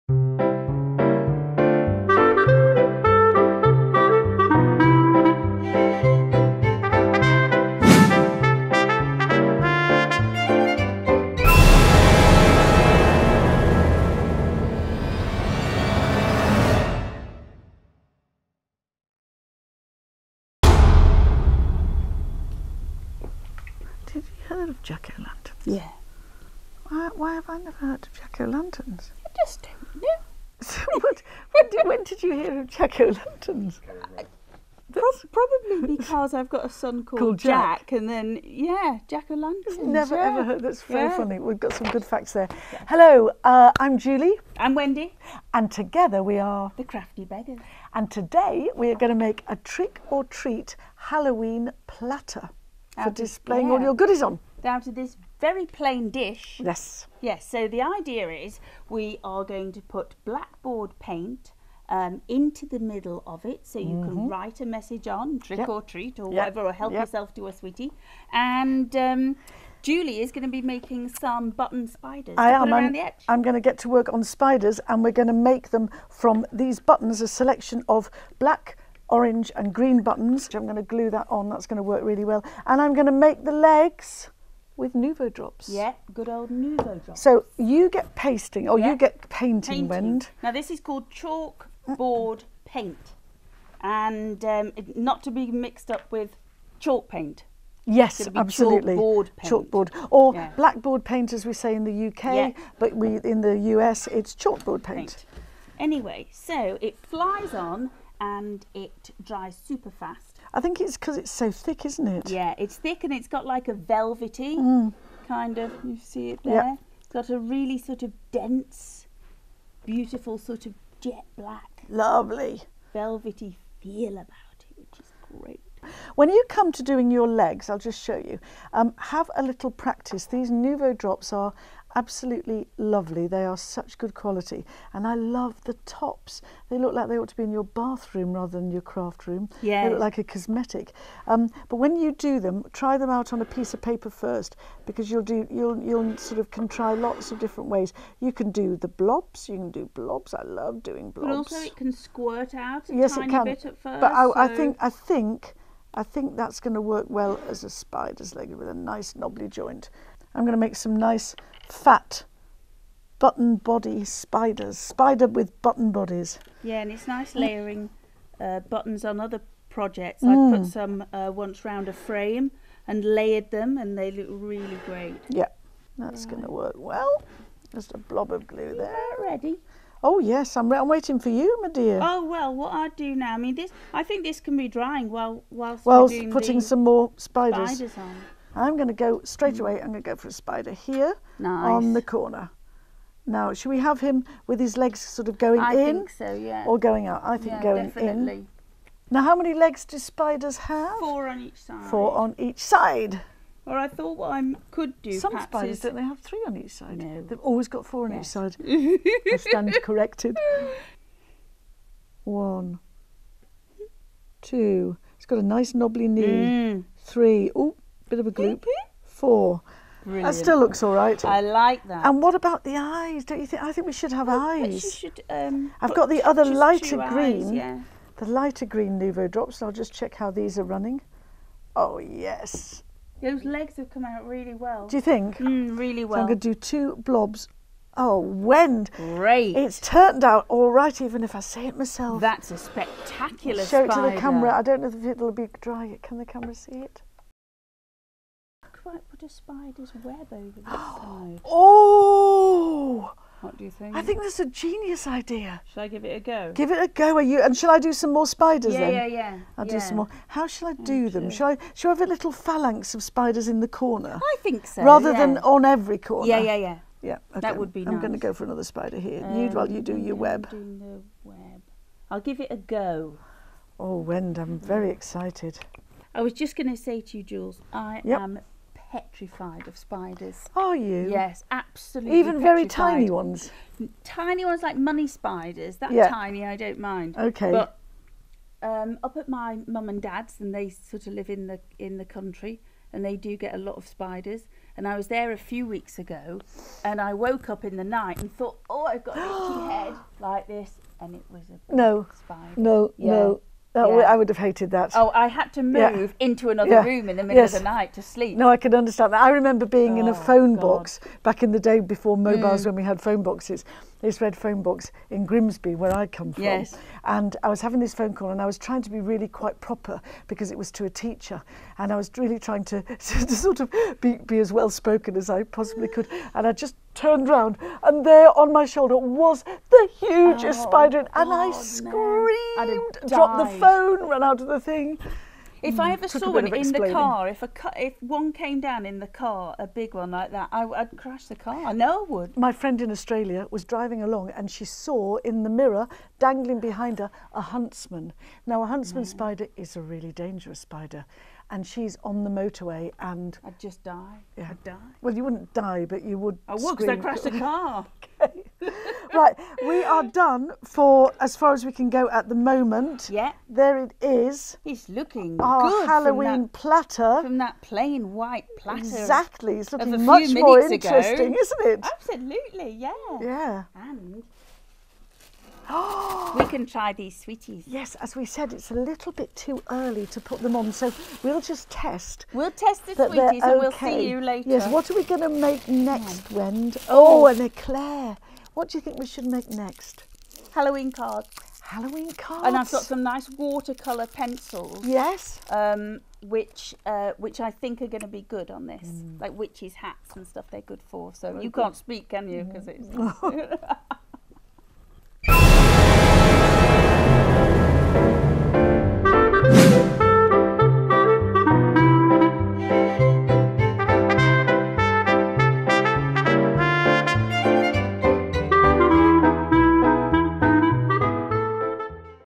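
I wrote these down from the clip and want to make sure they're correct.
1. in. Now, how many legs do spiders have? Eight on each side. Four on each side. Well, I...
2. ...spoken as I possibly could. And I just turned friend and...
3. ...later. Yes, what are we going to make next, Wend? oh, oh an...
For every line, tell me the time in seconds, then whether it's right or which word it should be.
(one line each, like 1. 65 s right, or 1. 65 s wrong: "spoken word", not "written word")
1. 198 s wrong: "Four", not "Eight"
2. 324 s wrong: "round", not "friend"
3. 384 s right.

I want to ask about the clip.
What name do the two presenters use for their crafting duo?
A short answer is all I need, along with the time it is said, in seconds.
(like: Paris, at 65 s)
The Crafty Beggars, at 46 s.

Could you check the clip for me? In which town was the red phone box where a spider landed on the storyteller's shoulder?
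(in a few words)
Grimsby.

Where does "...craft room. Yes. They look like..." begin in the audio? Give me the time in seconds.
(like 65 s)
138 s.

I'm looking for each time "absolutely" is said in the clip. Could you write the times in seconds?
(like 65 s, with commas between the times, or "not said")
98 s, 131 s, 281 s, 371 s.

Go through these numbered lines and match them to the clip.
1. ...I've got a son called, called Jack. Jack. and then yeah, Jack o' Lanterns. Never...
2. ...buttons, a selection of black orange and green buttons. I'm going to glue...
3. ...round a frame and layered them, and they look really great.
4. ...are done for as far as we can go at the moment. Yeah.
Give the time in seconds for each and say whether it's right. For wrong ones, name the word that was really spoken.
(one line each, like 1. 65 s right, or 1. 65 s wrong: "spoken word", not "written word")
1. 36 s right
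2. 76 s right
3. 171 s right
4. 359 s right.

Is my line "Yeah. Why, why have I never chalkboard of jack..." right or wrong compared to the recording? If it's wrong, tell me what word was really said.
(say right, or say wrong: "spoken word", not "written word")
wrong: "heard", not "chalkboard".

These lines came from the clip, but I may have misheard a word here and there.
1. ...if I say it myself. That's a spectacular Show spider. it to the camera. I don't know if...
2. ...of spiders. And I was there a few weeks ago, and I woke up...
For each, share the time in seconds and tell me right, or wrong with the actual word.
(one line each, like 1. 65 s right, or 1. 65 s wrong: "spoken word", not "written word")
1. 241 s right
2. 293 s right.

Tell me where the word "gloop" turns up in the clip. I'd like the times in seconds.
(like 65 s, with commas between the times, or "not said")
218 s.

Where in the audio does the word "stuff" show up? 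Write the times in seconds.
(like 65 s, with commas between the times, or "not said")
400 s.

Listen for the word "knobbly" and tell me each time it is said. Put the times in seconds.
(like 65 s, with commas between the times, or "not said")
159 s, 215 s.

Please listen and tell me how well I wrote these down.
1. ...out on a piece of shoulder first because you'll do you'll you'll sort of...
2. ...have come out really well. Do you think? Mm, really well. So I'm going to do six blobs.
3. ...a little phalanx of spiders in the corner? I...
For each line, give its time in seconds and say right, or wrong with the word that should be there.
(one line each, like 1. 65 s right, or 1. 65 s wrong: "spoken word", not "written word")
1. 143 s wrong: "paper", not "shoulder"
2. 233 s wrong: "two", not "six"
3. 262 s right.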